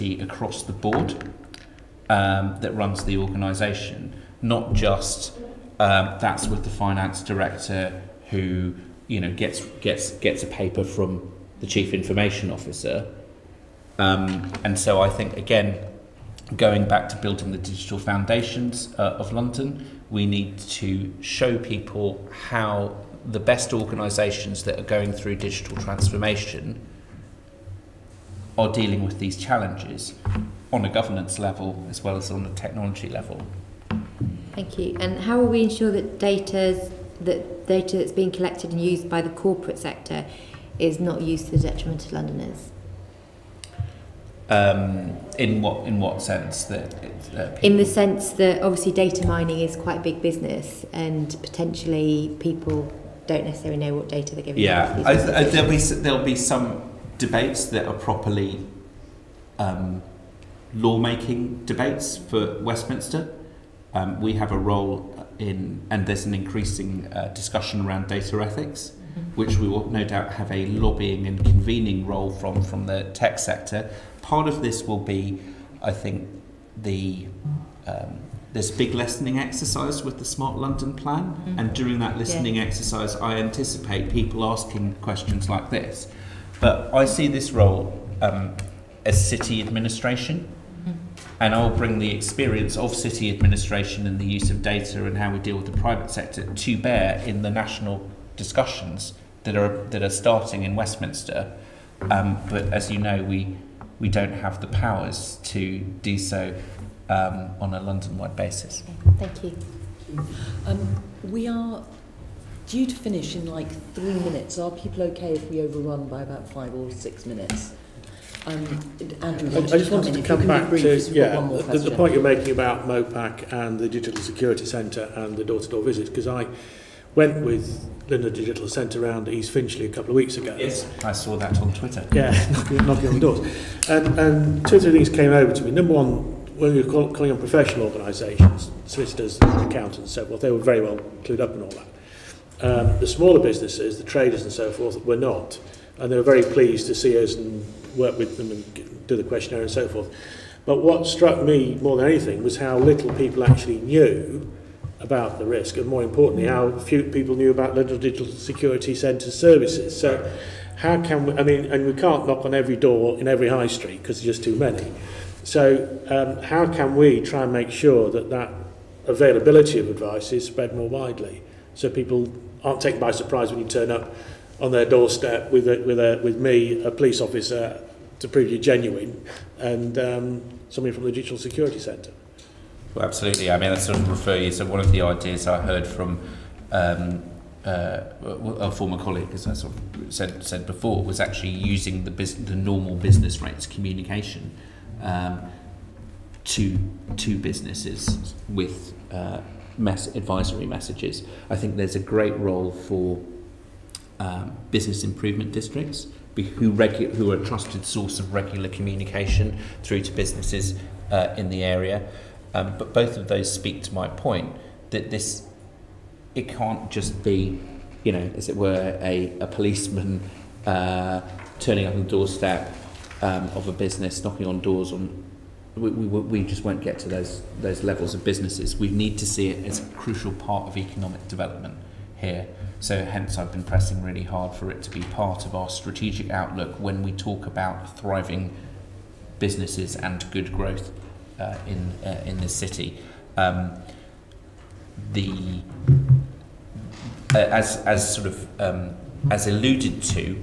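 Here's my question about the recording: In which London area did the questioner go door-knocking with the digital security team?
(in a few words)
East Finchley.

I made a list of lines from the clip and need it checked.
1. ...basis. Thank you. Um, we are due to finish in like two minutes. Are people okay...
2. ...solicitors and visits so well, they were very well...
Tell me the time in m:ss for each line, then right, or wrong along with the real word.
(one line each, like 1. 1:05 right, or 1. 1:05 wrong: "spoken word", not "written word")
1. 1:48 wrong: "three", not "two"
2. 2:18 wrong: "accountants", not "visits".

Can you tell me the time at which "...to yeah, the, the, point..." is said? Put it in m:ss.
2:00.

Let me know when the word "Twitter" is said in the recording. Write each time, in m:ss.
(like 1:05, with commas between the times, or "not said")
2:11.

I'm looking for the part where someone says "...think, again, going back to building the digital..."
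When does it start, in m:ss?
0:15.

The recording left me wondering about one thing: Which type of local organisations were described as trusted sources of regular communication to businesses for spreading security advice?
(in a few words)
business improvement districts.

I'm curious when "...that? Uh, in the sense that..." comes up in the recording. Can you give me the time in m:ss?
0:46.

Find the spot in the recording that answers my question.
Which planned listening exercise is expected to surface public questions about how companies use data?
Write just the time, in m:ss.
1:20.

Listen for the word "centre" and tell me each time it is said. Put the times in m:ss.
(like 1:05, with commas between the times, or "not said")
2:04, 2:38, 3:01.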